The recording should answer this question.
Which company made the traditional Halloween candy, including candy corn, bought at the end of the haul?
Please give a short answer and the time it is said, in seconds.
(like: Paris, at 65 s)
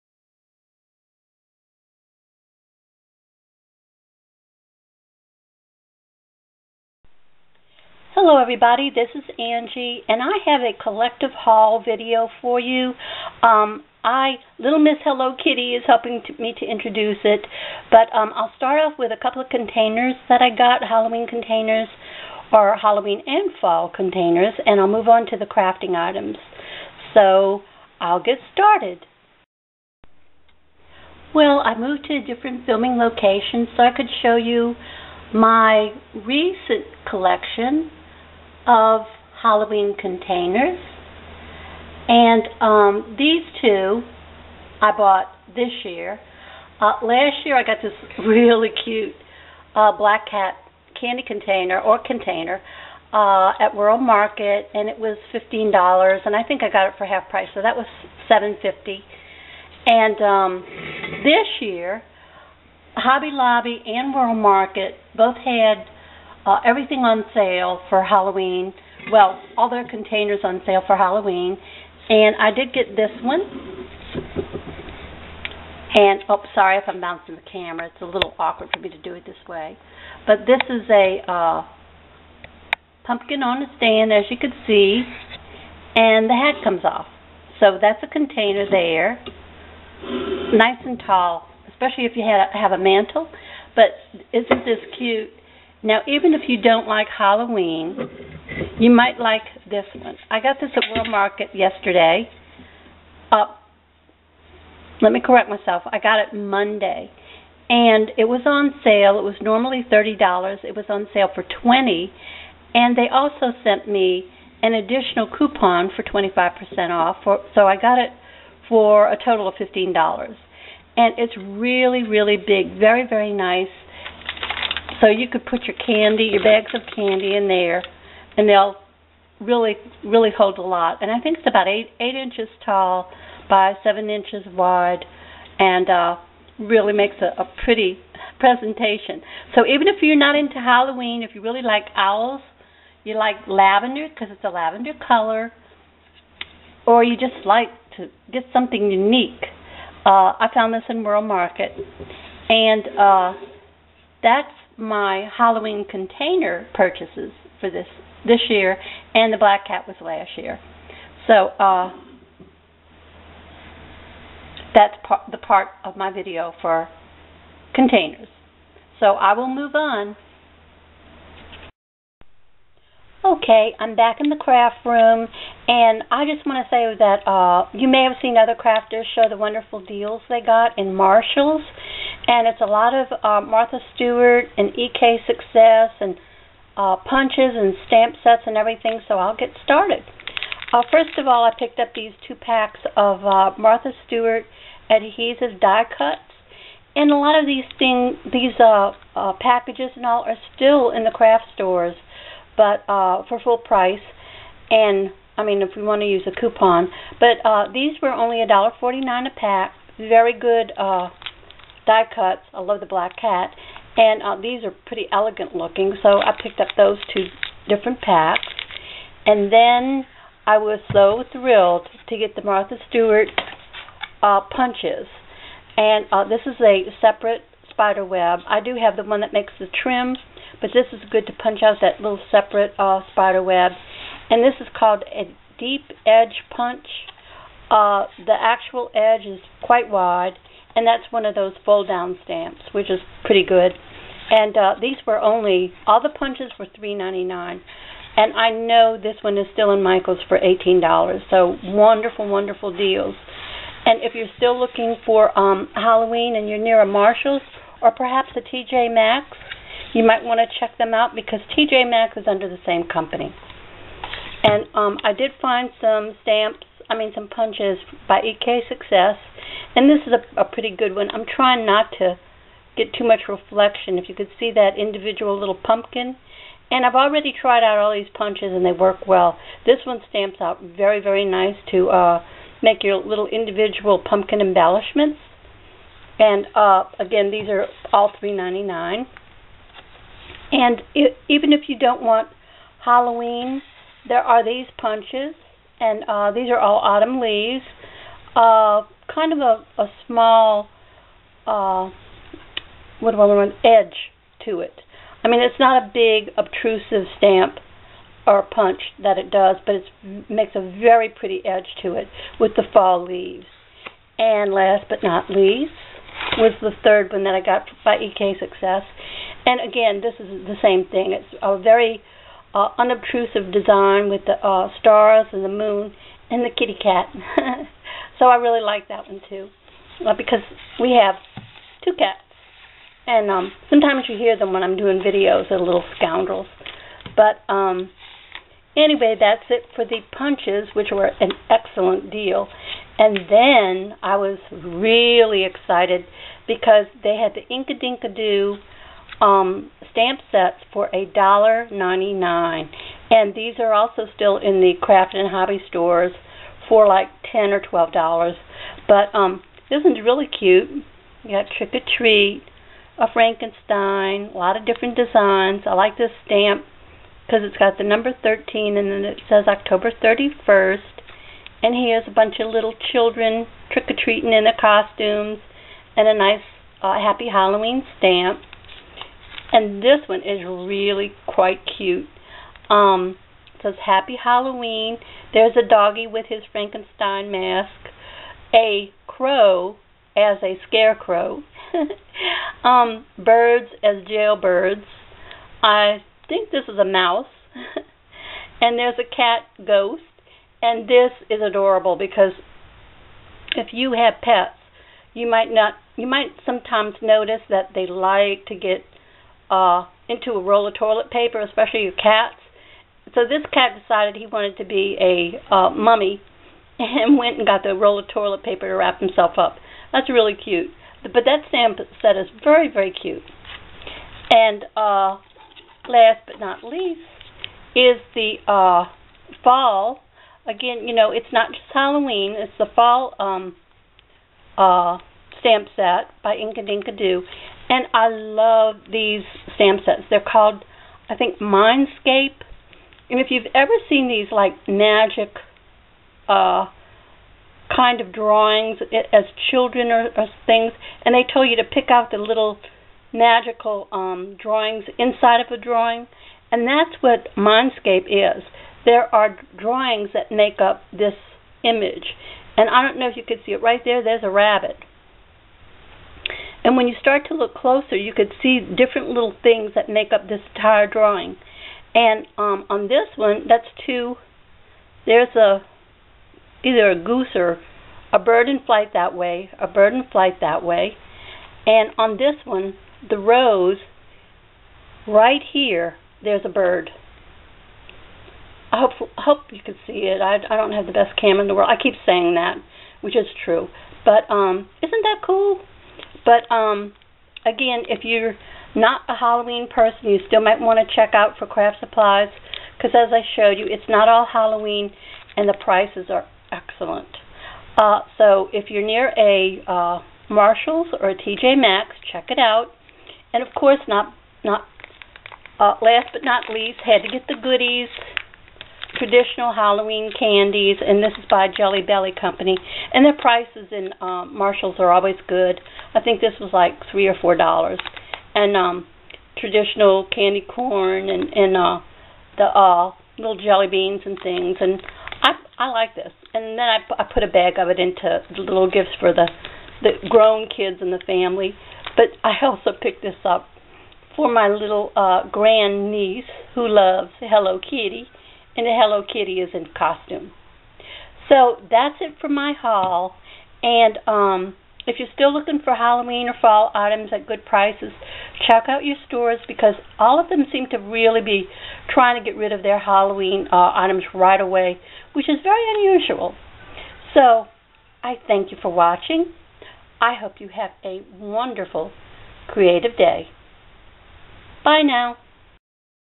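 Jelly Belly, at 521 s.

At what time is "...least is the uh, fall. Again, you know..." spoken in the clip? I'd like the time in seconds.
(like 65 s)
426 s.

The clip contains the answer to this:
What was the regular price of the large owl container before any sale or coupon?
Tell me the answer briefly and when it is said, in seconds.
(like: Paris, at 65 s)
$30, at 109 s.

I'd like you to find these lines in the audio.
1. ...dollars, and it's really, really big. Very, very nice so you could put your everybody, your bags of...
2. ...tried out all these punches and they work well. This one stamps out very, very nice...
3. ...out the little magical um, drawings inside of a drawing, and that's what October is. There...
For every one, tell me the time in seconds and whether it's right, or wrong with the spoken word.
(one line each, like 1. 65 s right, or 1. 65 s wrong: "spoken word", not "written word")
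1. 119 s wrong: "candy", not "everybody"
2. 277 s right
3. 451 s wrong: "Mindscape", not "October".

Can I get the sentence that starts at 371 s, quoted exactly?
And here's a bunch of little children trick or treating in their costumes and a nice uh, Happy Halloween stamp.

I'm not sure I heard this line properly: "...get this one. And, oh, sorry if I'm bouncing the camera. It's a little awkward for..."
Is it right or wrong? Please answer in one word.
right.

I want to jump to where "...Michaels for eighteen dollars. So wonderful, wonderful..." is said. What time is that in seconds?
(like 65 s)
249 s.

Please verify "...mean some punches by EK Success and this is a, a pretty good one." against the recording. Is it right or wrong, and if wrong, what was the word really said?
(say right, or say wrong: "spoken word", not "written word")
right.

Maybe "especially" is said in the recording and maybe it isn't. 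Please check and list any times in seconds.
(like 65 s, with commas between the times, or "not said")
91 s, 411 s.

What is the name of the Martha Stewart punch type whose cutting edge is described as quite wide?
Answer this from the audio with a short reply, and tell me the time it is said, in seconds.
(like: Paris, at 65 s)
Deep edge punch, at 235 s.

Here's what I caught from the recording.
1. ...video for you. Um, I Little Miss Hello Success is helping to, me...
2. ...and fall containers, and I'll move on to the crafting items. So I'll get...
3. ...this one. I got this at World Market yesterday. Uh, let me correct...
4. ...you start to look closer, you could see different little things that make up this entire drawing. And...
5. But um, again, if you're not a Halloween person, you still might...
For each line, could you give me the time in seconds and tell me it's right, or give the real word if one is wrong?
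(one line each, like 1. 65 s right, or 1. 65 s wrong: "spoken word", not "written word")
1. 11 s wrong: "Kitty", not "Success"
2. 23 s right
3. 99 s right
4. 466 s right
5. 496 s right.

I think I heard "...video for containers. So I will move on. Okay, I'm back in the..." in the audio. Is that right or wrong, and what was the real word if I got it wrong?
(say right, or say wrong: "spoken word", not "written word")
right.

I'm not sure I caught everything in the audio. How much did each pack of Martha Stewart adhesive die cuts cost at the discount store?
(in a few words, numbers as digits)
$1.49.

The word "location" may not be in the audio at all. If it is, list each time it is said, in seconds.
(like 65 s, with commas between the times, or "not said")
33 s.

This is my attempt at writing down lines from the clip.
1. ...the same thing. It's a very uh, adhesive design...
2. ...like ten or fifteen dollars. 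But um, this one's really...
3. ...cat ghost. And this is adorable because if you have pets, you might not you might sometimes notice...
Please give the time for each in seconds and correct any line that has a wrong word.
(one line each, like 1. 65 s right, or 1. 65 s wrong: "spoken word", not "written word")
1. 320 s wrong: "unobtrusive", not "adhesive"
2. 356 s wrong: "twelve", not "fifteen"
3. 399 s right.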